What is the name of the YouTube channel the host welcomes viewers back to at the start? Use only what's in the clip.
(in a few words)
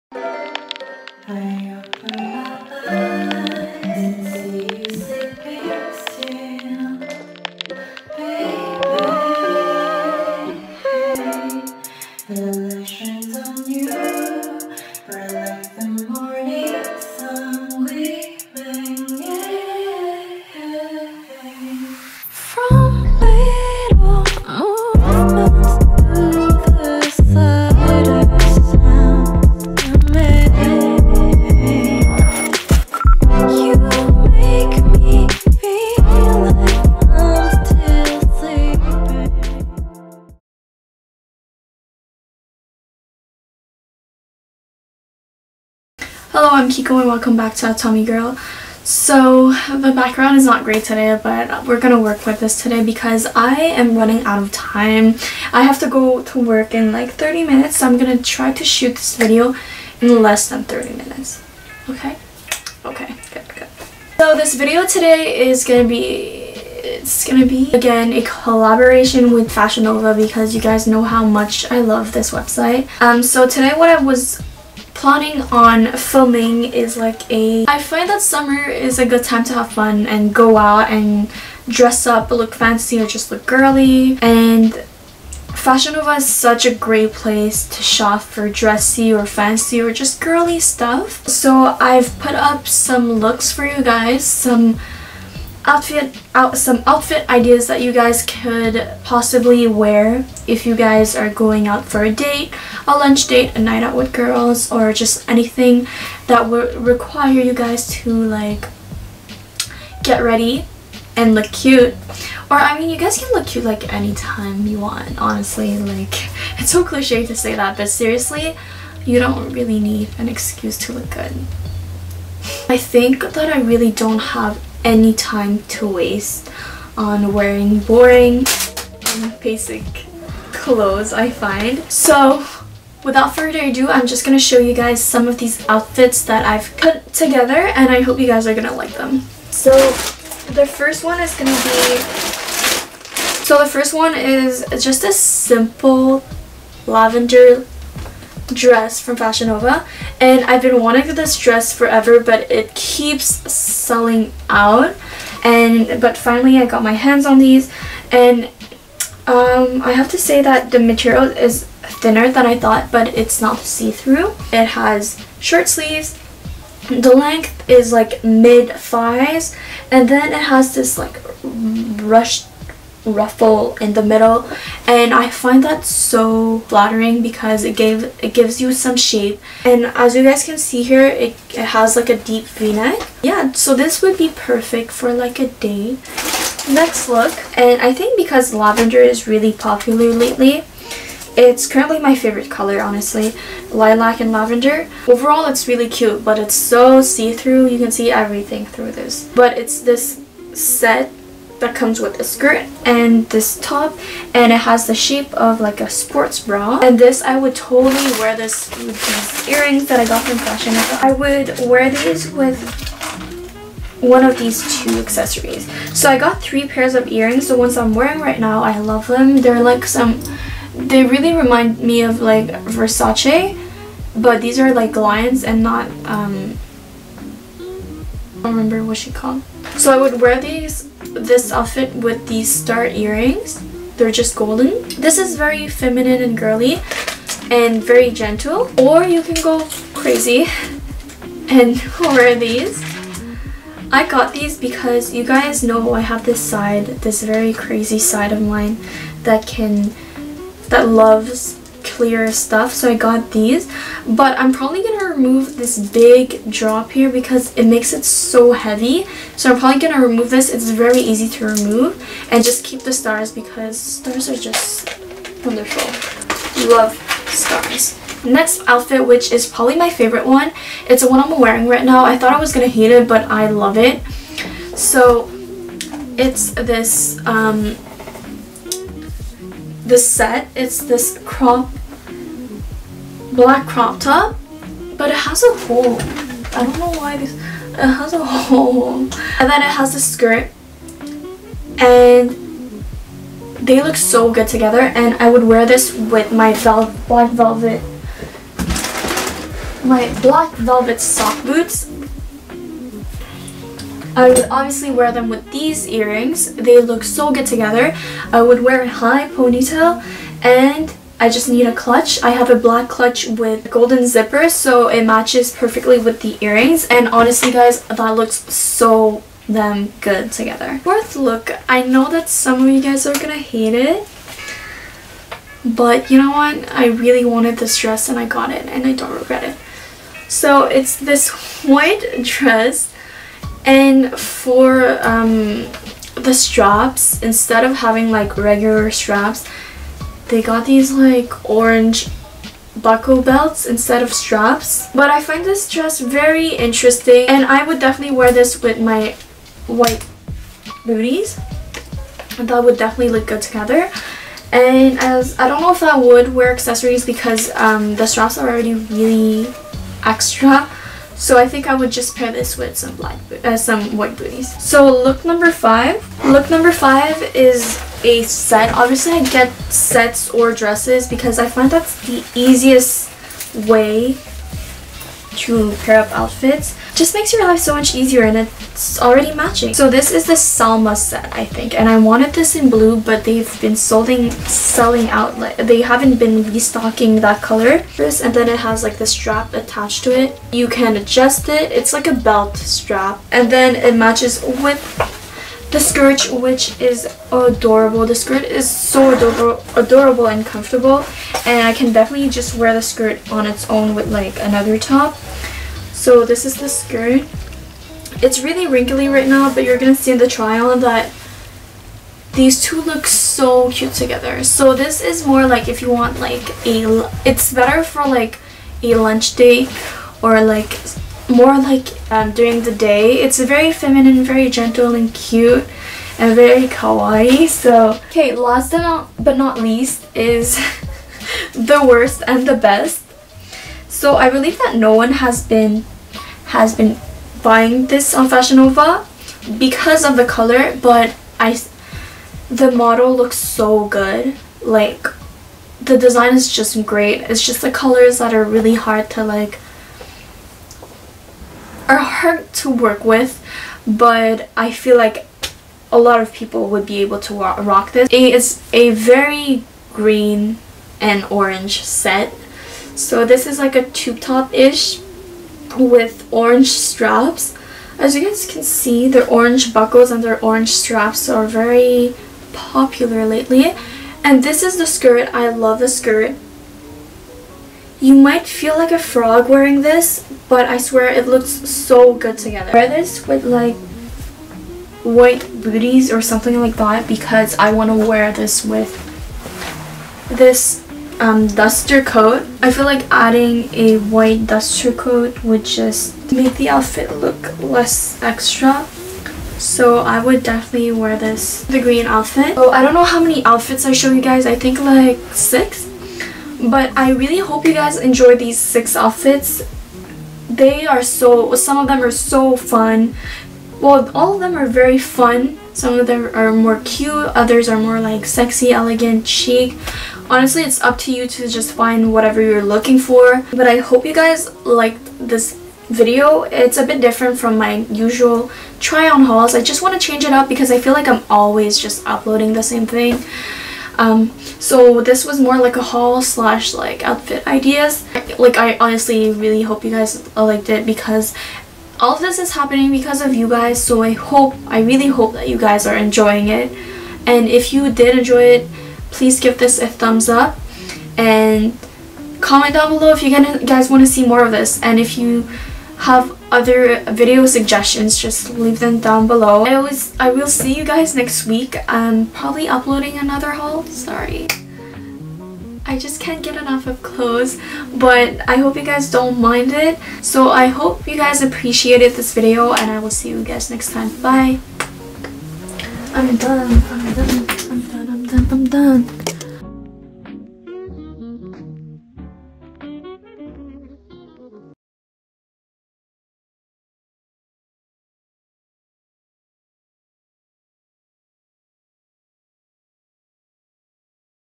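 Tommy Girl.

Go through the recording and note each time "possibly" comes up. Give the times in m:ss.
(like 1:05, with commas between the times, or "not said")
1:39.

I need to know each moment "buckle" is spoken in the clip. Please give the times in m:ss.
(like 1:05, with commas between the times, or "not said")
5:42, 7:49.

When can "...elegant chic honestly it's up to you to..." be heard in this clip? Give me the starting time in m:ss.
8:38.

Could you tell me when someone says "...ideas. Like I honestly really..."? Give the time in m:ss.
8:57.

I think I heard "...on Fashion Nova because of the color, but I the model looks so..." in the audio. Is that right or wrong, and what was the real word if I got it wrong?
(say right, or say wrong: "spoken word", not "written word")
right.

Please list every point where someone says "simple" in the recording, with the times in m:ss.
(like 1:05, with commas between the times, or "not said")
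2:25.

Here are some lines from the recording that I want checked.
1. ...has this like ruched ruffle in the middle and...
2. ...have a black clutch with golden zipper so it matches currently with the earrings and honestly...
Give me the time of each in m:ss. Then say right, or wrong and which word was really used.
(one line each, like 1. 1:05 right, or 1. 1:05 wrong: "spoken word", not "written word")
1. 2:50 right
2. 5:12 wrong: "perfectly", not "currently".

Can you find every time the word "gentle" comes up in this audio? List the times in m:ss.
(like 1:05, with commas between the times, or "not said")
3:58, 7:04.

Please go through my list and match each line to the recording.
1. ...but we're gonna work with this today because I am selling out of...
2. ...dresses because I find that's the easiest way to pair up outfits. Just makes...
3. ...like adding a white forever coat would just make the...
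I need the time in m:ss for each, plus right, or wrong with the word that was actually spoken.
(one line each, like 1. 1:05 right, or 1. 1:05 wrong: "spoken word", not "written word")
1. 0:51 wrong: "running", not "selling"
2. 6:10 right
3. 8:12 wrong: "duster", not "forever".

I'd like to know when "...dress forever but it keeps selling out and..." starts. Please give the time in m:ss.
2:31.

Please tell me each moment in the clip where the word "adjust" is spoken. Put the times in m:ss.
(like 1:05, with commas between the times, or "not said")
6:30.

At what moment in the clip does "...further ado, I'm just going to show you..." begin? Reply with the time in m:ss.
2:13.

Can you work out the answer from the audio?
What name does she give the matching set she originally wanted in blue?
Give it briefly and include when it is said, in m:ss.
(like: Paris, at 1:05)
Salma set, at 6:20.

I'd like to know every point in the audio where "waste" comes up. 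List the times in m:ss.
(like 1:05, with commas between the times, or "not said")
2:05.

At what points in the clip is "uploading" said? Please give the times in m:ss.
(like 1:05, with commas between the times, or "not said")
8:52, 9:22.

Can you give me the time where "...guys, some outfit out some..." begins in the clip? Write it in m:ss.
1:33.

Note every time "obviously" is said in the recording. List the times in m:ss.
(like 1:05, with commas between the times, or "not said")
5:04, 6:08.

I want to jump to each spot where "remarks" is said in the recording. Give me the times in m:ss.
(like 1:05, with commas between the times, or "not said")
not said.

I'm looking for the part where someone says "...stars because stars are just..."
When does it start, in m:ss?
4:22.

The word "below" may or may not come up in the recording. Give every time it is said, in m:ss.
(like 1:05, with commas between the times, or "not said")
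9:12, 9:19.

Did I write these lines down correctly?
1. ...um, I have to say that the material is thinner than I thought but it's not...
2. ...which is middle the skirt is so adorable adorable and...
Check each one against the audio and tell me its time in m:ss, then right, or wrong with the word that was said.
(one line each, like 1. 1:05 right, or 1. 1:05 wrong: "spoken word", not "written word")
1. 2:39 right
2. 6:36 wrong: "adorable", not "middle".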